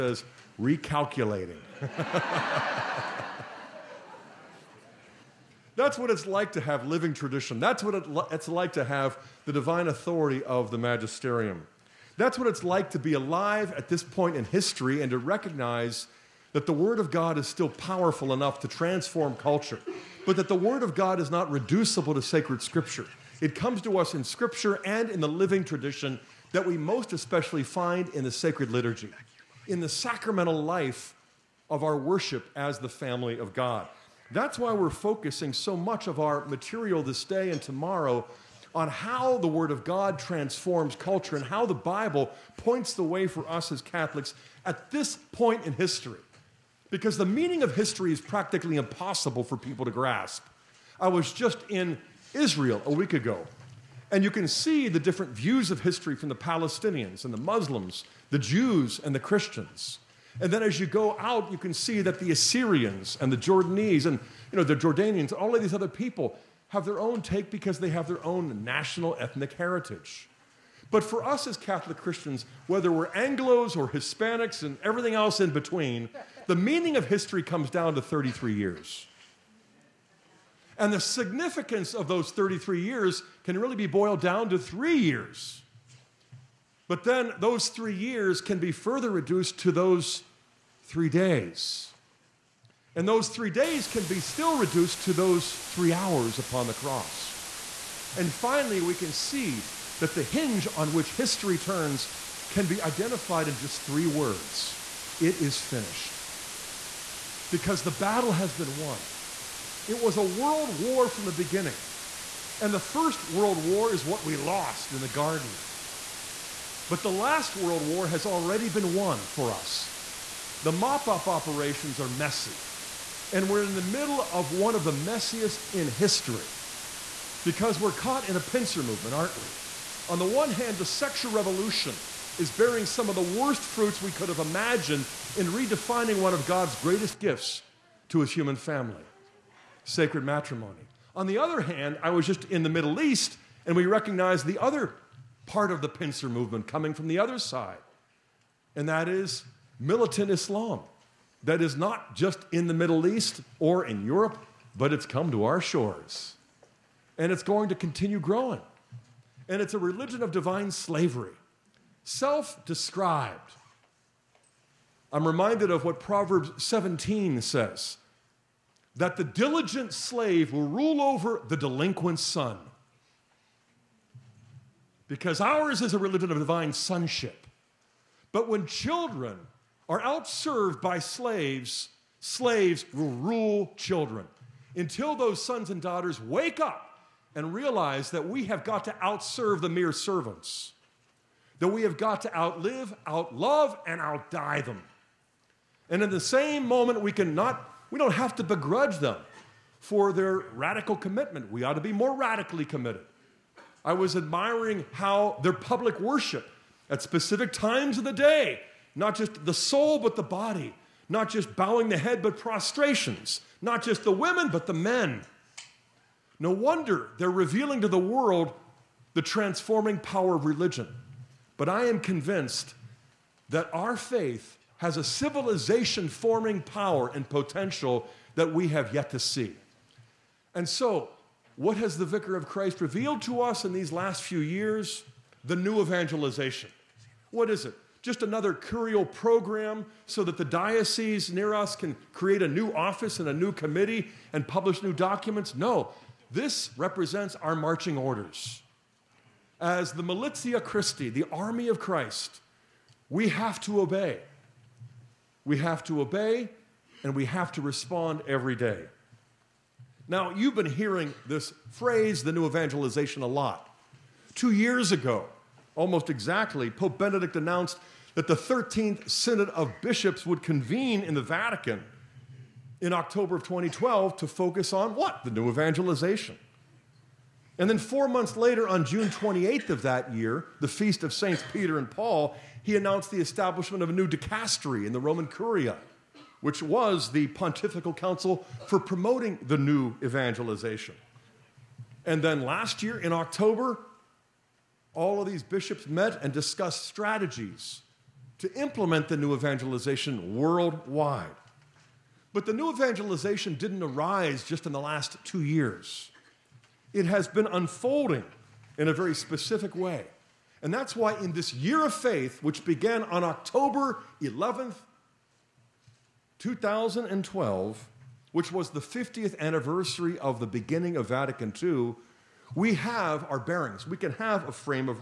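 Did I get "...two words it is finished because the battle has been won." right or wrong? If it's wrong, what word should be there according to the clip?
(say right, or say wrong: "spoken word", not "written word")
wrong: "three", not "two".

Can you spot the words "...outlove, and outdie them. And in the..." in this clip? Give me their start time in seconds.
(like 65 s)
193 s.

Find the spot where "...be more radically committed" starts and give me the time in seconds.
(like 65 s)
201 s.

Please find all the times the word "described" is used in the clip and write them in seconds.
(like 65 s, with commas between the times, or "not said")
162 s.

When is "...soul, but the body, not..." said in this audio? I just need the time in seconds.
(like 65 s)
209 s.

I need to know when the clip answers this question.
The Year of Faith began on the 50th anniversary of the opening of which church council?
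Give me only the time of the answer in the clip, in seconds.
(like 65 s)
321 s.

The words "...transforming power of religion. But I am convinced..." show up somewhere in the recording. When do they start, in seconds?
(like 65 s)
219 s.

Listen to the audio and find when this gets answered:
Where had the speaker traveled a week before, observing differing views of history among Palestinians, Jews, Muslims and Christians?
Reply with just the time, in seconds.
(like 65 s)
52 s.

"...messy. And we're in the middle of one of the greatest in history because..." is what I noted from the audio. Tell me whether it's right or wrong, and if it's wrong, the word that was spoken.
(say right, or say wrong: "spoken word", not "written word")
wrong: "messiest", not "greatest".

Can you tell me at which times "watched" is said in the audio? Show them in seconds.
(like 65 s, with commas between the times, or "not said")
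not said.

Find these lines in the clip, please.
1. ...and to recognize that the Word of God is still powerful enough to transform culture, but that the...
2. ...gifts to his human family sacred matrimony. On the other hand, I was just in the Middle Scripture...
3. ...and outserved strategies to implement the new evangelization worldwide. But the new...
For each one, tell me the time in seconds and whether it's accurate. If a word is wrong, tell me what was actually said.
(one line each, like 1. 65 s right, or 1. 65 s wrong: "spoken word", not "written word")
1. 15 s right
2. 137 s wrong: "East", not "Scripture"
3. 296 s wrong: "discussed", not "outserved".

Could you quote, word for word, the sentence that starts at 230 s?
And so, what has the Vicar of Christ revealed to us in these last few years?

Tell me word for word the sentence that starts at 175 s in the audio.
Because ours is a religion of divine sonship.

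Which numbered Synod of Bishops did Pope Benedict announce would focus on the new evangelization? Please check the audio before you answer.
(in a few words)
13th.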